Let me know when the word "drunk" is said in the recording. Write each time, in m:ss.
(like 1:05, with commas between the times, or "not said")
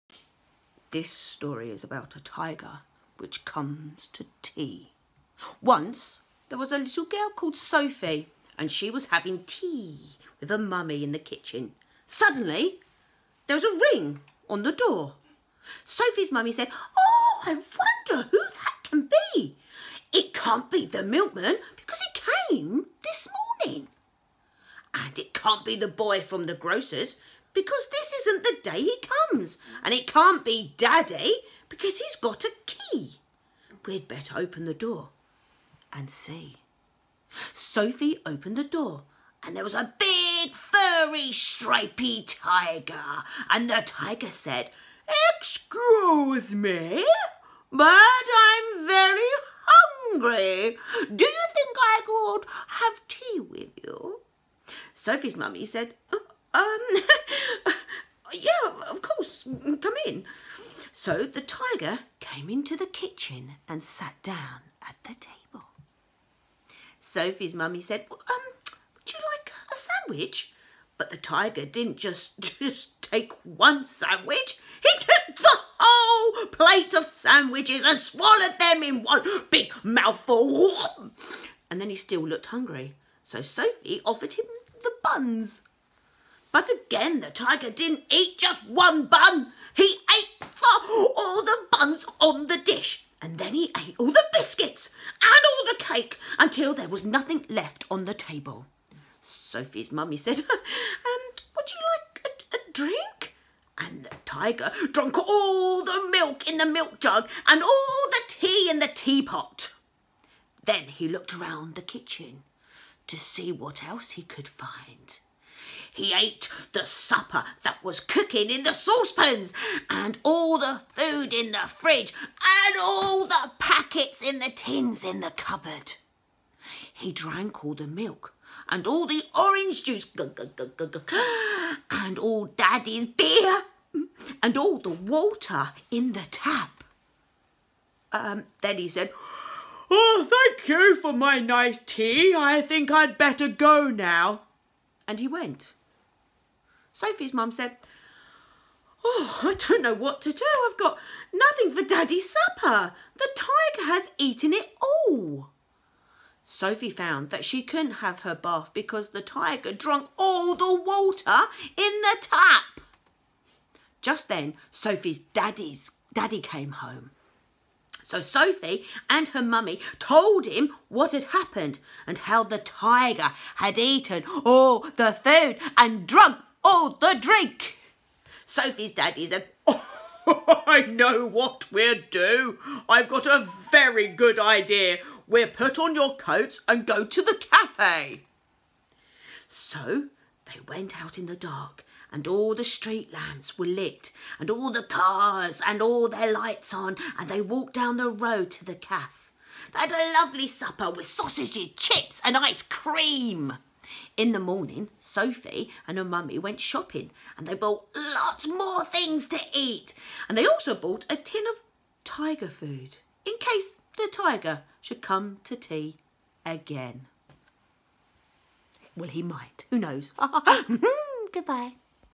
2:39, 2:56.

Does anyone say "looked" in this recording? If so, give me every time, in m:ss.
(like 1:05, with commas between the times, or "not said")
1:22, 1:51.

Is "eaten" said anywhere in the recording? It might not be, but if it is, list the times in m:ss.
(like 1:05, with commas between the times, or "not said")
2:34, 2:53.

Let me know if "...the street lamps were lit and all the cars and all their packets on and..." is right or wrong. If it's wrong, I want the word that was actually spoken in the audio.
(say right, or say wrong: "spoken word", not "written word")
wrong: "lights", not "packets".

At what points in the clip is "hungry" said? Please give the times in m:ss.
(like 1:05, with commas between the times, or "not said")
0:49, 1:22.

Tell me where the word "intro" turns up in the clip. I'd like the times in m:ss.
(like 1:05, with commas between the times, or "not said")
not said.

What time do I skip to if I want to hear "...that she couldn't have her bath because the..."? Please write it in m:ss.
2:37.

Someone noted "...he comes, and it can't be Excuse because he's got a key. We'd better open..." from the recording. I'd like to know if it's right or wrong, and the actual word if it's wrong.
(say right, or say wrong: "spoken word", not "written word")
wrong: "Daddy", not "Excuse".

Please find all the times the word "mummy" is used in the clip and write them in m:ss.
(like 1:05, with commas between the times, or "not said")
0:10, 0:16, 0:55, 1:07, 1:39, 2:49, 3:26.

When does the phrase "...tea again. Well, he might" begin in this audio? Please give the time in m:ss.
3:35.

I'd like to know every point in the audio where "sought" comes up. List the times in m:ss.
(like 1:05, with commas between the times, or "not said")
not said.